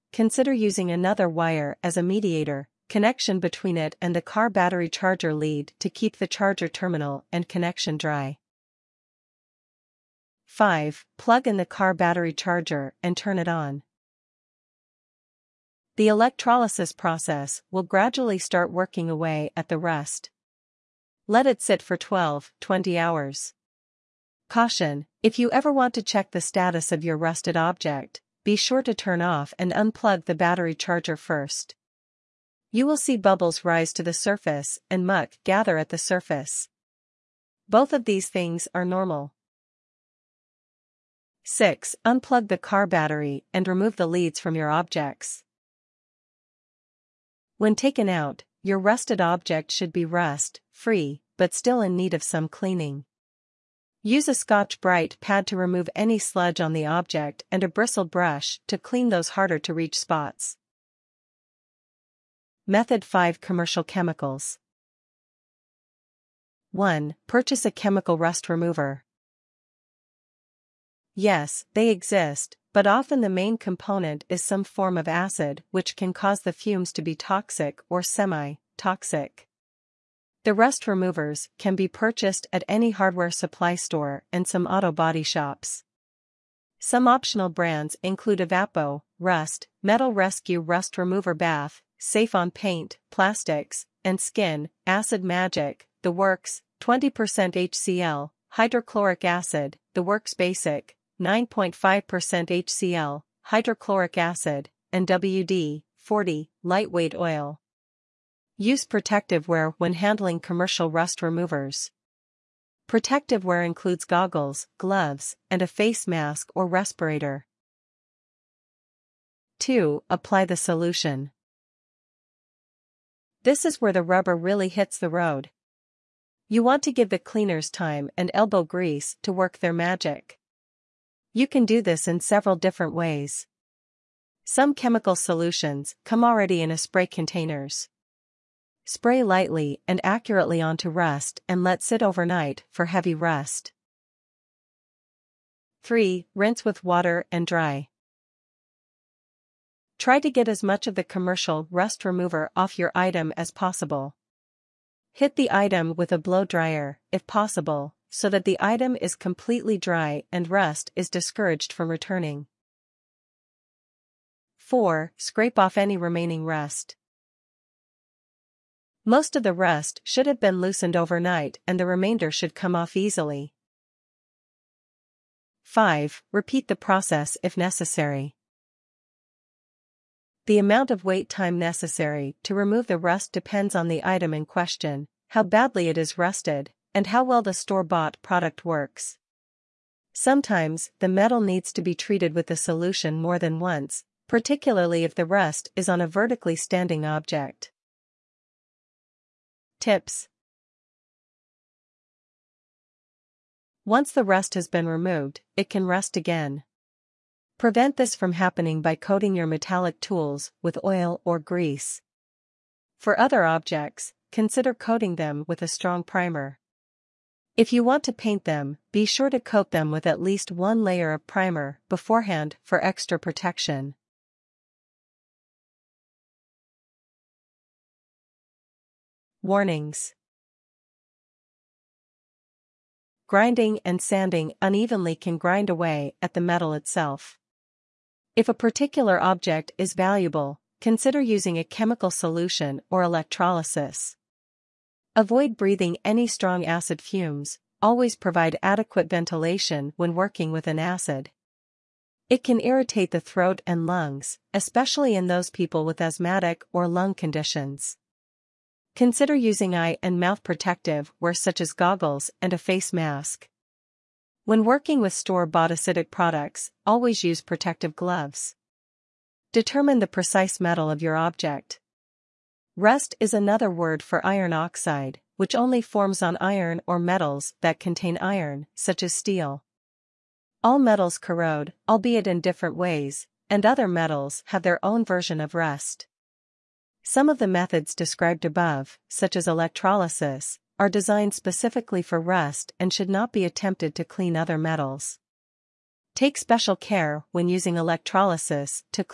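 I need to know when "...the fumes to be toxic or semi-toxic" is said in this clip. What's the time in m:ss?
1:16.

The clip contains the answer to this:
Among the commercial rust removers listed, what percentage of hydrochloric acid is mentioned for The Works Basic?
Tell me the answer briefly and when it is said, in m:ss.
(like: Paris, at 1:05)
9.5%, at 1:41.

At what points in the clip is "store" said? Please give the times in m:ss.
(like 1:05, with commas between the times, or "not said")
1:23, 3:07, 4:25.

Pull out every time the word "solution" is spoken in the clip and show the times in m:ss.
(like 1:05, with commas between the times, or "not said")
2:00, 2:15, 3:12, 4:02.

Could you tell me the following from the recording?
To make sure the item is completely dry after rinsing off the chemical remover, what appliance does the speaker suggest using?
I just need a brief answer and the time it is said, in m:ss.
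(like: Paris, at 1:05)
A blow dryer, at 2:36.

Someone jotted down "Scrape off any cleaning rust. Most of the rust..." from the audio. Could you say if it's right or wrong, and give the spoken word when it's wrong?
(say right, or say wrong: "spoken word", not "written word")
wrong: "remaining", not "cleaning".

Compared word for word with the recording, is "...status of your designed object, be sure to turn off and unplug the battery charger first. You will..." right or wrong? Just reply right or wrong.
wrong.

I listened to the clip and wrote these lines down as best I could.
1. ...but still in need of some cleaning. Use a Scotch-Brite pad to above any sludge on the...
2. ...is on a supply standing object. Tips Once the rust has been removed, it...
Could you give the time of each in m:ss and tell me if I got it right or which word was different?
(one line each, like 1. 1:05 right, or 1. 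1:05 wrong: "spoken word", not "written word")
1. 0:51 wrong: "remove", not "above"
2. 3:15 wrong: "vertically", not "supply".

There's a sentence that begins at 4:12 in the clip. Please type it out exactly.
It can irritate the throat and lungs, especially in those people with asthmatic or lung conditions.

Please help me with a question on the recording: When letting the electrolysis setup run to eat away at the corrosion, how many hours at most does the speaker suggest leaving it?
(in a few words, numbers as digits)
20 hours.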